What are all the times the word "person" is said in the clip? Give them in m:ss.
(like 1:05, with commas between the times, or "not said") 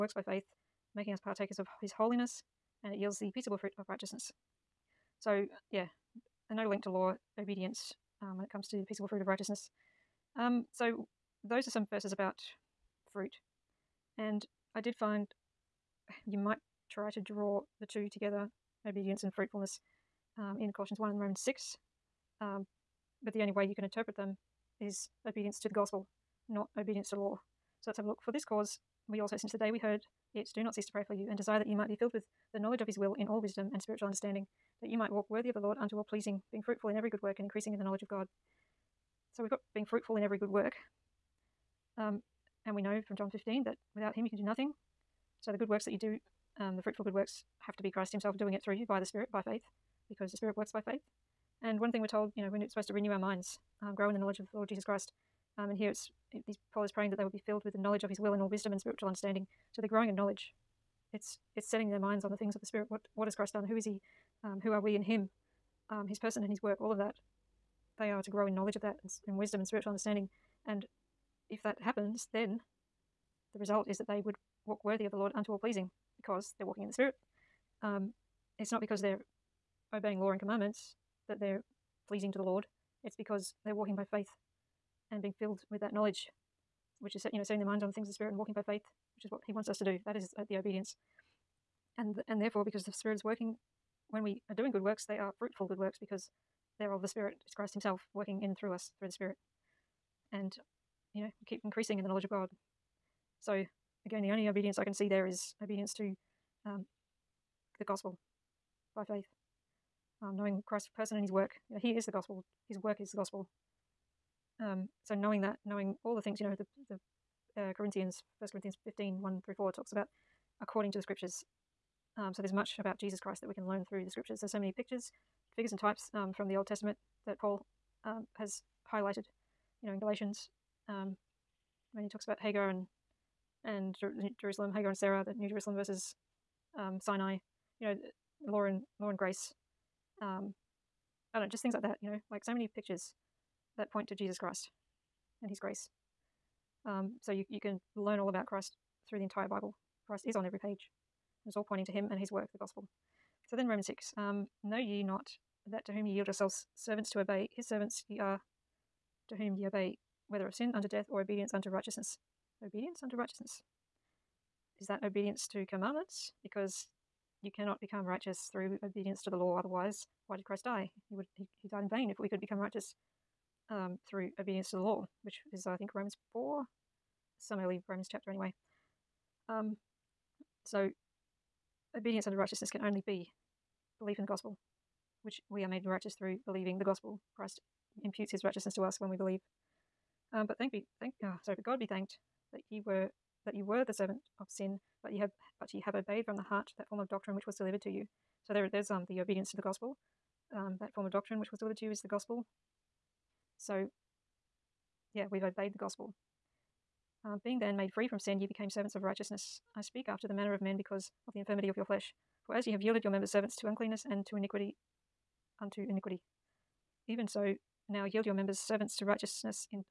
1:06, 1:50.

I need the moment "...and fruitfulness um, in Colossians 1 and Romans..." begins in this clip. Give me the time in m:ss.
0:19.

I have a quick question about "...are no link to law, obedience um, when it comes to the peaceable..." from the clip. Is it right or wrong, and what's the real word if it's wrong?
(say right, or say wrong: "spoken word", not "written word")
right.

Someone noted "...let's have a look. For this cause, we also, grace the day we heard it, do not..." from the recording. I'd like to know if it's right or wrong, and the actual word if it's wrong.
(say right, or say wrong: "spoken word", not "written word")
wrong: "since", not "grace".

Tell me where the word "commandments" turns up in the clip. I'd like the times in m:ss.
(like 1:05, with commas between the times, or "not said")
1:20, 2:45.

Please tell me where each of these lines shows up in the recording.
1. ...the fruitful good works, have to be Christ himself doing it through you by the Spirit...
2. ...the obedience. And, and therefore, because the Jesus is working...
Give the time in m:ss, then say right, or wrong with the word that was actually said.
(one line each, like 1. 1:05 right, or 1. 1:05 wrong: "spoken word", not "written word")
1. 0:46 right
2. 1:30 wrong: "Spirit", not "Jesus".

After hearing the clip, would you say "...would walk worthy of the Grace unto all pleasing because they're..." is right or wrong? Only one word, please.
wrong.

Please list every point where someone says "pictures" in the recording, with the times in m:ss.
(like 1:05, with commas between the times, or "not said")
2:04, 2:22.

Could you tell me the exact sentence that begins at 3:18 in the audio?
So there there's um the obedience to the gospel.